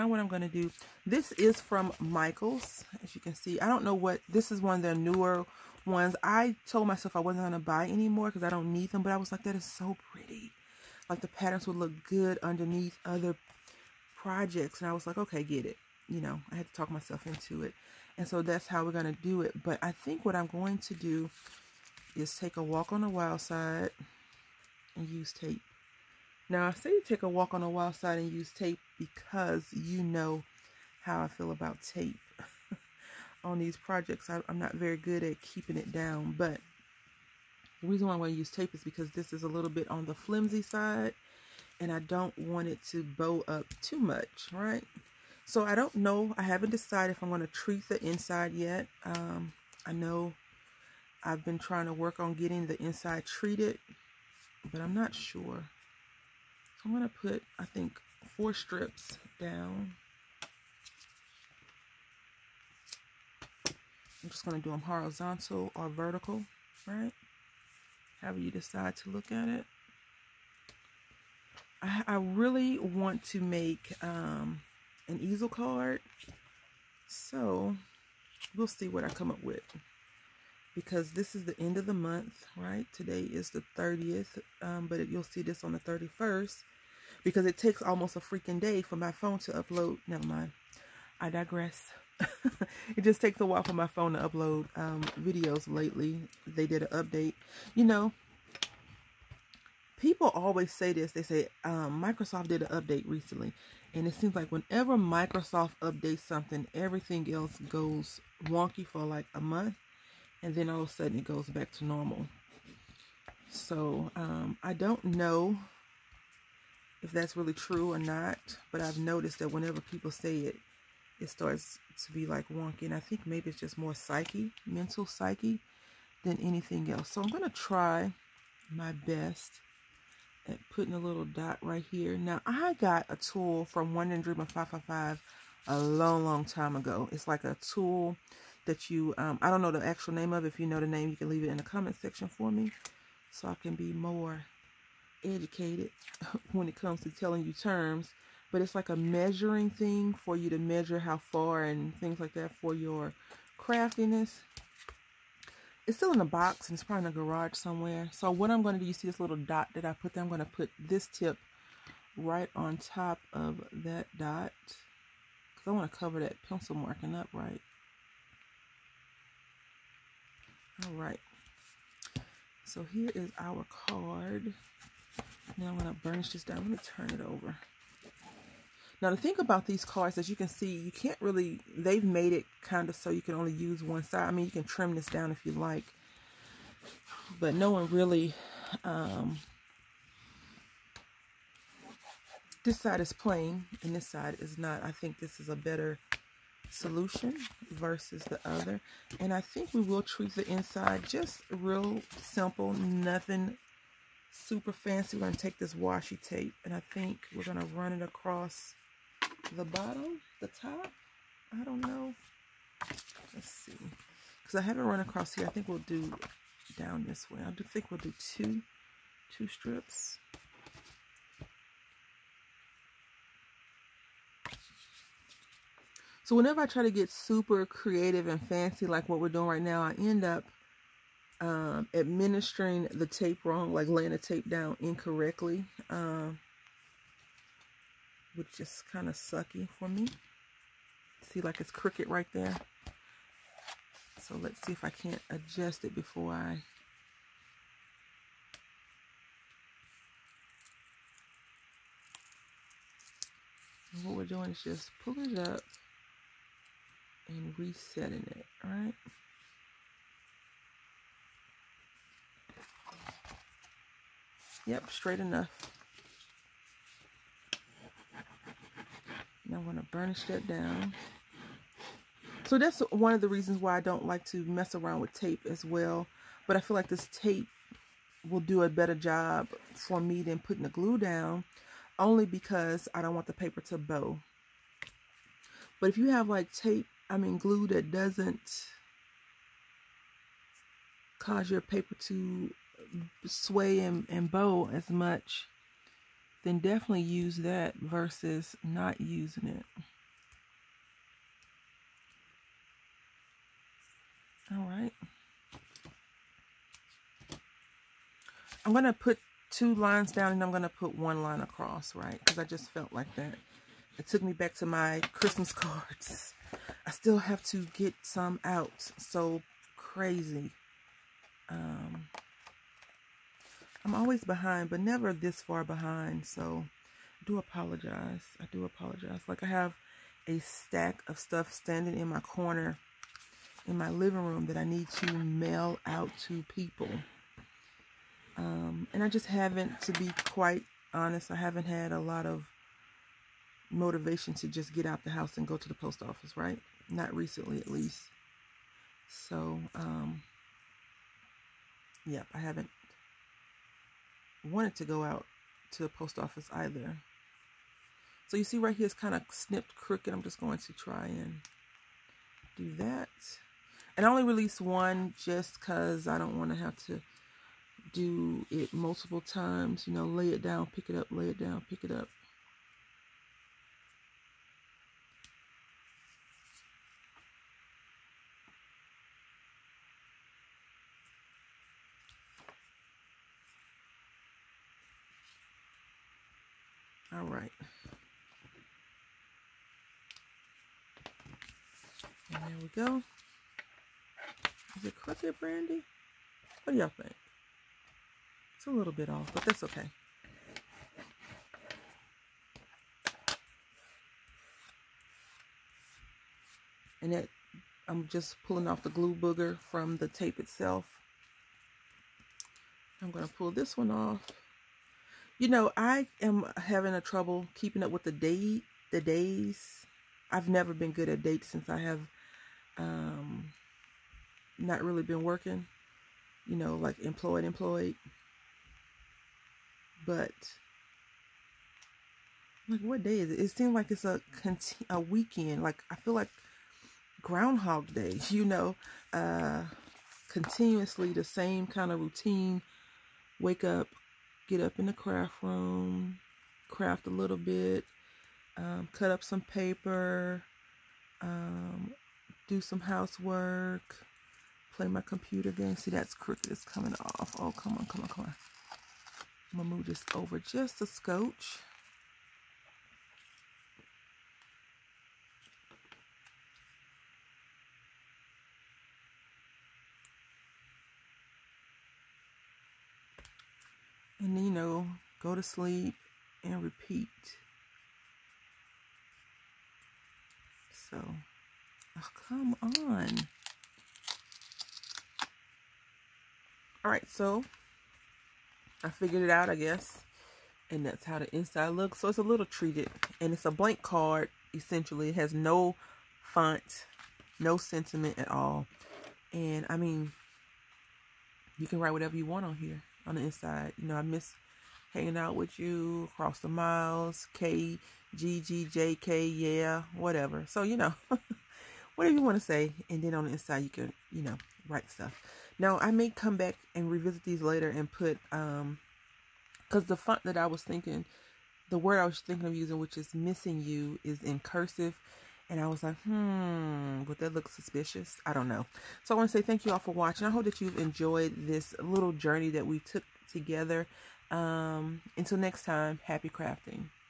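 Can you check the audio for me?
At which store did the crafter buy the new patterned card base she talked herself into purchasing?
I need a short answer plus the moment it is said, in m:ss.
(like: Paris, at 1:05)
Michaels, at 0:01.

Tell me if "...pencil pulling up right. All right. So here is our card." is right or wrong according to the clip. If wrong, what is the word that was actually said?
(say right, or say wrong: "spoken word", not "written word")
wrong: "marking", not "pulling".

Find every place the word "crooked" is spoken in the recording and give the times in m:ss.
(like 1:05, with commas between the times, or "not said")
4:01, 5:59, 7:36.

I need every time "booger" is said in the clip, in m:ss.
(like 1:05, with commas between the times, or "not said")
6:49.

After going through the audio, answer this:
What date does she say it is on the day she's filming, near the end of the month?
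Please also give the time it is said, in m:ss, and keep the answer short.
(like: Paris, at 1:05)
30th, at 1:23.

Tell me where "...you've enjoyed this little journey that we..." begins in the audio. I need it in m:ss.
8:50.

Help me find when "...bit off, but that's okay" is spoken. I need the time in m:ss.
6:38.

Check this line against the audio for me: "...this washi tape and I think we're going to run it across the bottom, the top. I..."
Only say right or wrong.
right.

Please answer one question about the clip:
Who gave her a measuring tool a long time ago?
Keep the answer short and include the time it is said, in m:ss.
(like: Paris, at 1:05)
One Wonder Dreamer 555, at 2:13.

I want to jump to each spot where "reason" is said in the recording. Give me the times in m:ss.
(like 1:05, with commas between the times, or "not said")
0:37, 4:33.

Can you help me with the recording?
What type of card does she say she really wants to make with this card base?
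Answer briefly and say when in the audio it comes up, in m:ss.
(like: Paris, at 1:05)
An easel card, at 1:15.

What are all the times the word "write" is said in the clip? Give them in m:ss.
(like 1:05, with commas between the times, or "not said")
8:21, 8:34.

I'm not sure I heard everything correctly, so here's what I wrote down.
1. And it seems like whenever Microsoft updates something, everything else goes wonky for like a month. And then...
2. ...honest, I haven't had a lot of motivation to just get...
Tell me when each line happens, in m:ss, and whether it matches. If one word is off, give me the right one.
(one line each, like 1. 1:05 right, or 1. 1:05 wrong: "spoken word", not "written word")
1. 1:43 right
2. 5:40 right.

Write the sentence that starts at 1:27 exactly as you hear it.
Because it takes almost a freaking day for my phone to upload.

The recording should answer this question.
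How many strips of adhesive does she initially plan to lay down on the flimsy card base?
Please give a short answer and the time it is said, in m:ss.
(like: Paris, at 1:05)
4, at 0:58.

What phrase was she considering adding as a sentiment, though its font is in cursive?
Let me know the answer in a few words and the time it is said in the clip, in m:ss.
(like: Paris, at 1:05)
Missing you, at 8:43.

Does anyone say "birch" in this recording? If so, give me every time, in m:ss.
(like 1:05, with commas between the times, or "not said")
not said.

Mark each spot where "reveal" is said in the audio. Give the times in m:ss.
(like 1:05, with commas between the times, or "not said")
not said.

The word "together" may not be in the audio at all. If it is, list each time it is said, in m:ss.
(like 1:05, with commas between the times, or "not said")
8:53.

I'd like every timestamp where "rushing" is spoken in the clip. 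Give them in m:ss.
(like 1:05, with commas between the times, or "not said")
not said.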